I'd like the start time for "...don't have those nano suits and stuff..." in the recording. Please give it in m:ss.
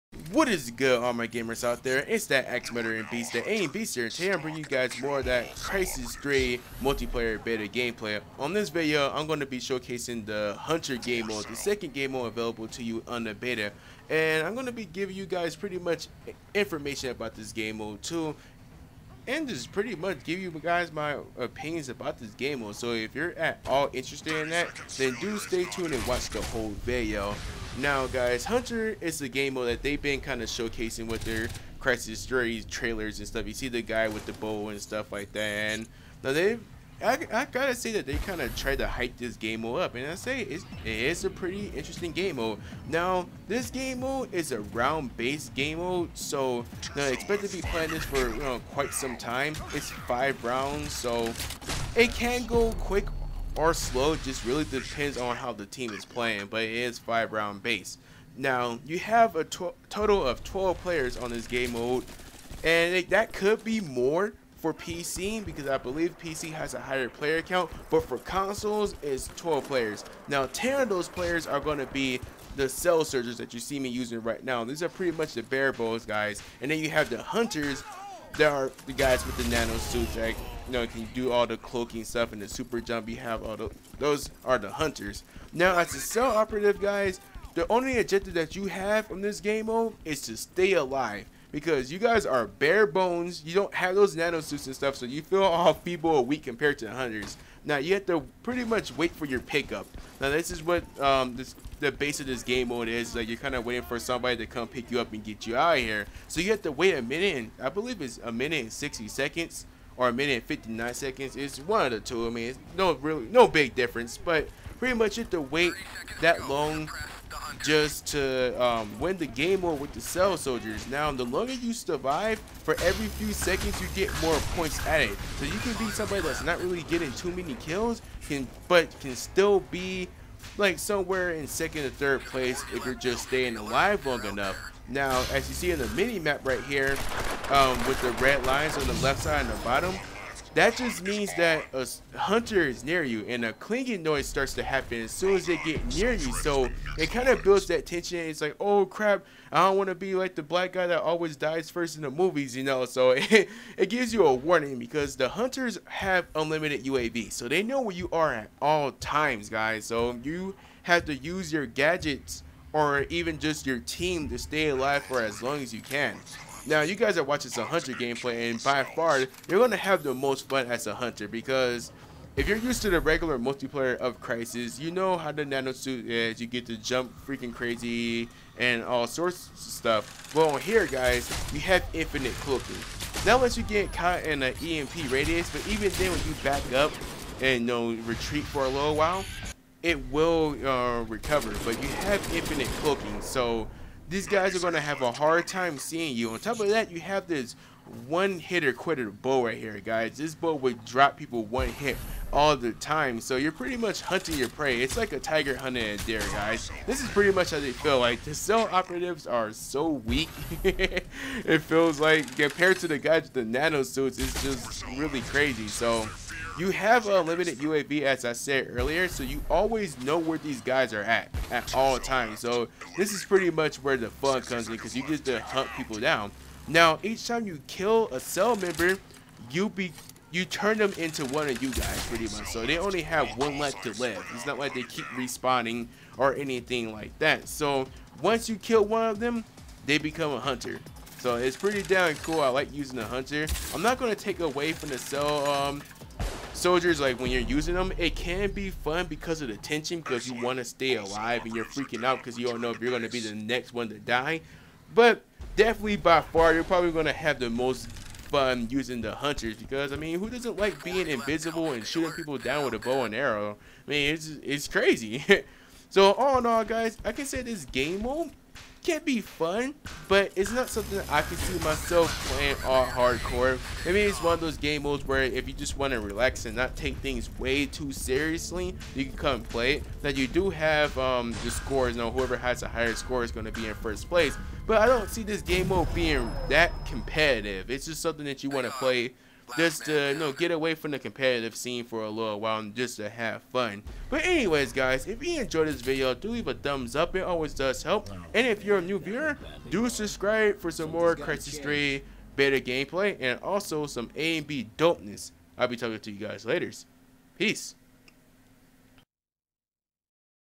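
1:33.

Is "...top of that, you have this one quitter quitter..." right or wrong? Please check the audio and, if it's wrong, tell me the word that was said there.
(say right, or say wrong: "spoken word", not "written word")
wrong: "hitter", not "quitter".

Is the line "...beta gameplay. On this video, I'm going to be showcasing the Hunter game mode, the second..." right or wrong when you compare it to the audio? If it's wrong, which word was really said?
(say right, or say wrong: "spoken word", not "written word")
right.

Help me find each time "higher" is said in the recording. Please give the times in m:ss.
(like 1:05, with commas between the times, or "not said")
1:06, 4:42.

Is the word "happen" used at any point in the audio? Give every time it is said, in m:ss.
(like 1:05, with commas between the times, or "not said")
2:24.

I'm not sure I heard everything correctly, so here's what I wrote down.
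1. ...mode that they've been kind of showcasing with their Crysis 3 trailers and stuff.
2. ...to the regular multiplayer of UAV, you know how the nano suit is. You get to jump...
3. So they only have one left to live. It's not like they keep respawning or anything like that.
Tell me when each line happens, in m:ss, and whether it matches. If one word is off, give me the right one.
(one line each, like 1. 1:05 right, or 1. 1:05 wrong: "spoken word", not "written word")
1. 0:29 right
2. 2:52 wrong: "Crysis", not "UAV"
3. 3:52 right.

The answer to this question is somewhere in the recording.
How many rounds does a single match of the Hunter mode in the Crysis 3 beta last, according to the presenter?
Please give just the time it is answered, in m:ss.
0:49.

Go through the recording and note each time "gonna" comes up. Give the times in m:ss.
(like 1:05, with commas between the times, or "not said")
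2:49, 4:03.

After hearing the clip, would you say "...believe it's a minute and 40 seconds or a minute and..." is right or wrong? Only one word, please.
wrong.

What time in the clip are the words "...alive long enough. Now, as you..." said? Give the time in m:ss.
2:13.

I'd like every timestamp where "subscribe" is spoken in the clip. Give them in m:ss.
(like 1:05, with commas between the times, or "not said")
4:59.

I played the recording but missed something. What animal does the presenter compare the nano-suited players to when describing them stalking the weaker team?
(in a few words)
tiger.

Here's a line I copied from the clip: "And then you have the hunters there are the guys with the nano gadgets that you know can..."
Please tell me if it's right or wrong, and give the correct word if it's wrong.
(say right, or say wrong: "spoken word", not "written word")
wrong: "suits", not "gadgets".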